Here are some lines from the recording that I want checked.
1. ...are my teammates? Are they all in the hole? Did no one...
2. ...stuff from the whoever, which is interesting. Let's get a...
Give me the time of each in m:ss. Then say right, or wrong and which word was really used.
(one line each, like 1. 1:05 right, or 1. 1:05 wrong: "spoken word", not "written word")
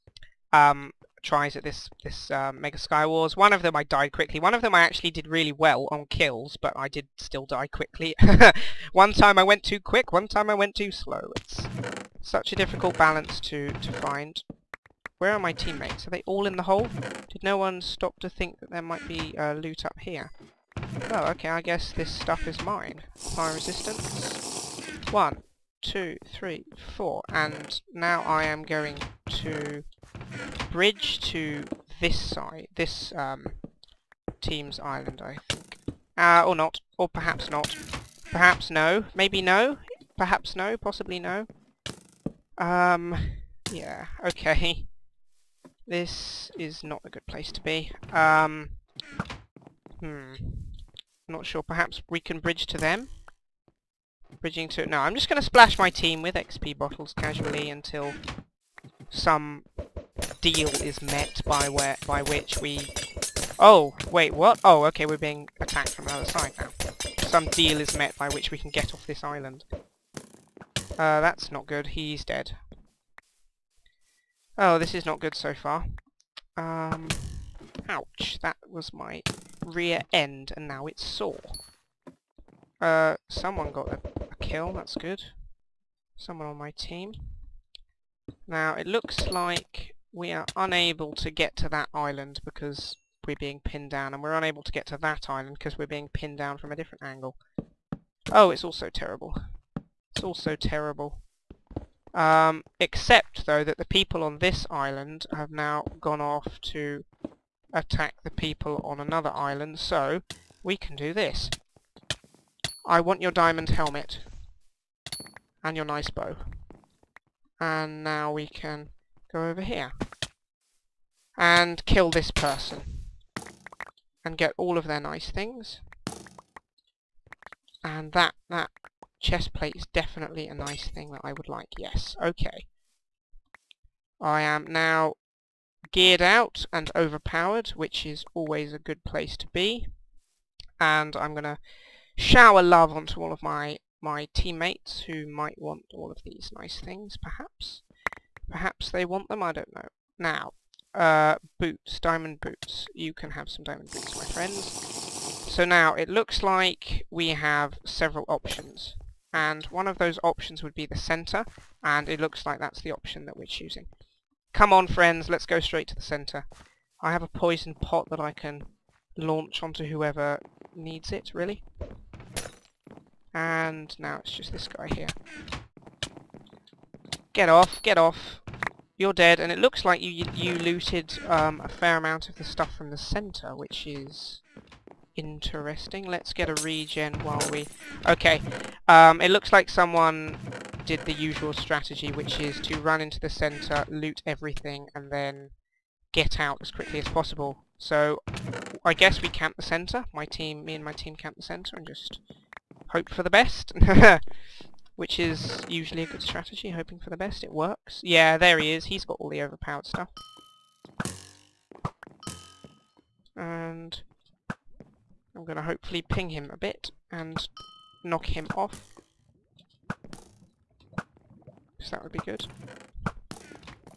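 1. 0:15 right
2. 3:02 wrong: "center", not "whoever".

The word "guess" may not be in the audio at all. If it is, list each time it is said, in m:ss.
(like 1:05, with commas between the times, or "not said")
0:21, 3:18.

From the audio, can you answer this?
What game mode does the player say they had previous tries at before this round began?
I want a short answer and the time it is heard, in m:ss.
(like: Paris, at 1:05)
Mega Skywars, at 0:02.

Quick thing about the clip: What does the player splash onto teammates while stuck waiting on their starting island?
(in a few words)
XP bottles.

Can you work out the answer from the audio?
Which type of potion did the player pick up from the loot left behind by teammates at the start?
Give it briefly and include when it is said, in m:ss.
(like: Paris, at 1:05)
Fire resistance, at 0:23.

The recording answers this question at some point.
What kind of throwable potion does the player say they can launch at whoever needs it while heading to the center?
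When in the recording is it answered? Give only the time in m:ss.
2:47.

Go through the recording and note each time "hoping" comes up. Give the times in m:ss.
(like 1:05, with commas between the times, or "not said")
3:26.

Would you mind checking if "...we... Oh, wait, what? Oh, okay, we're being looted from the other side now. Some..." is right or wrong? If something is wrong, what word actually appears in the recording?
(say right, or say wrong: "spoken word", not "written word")
wrong: "attacked", not "looted".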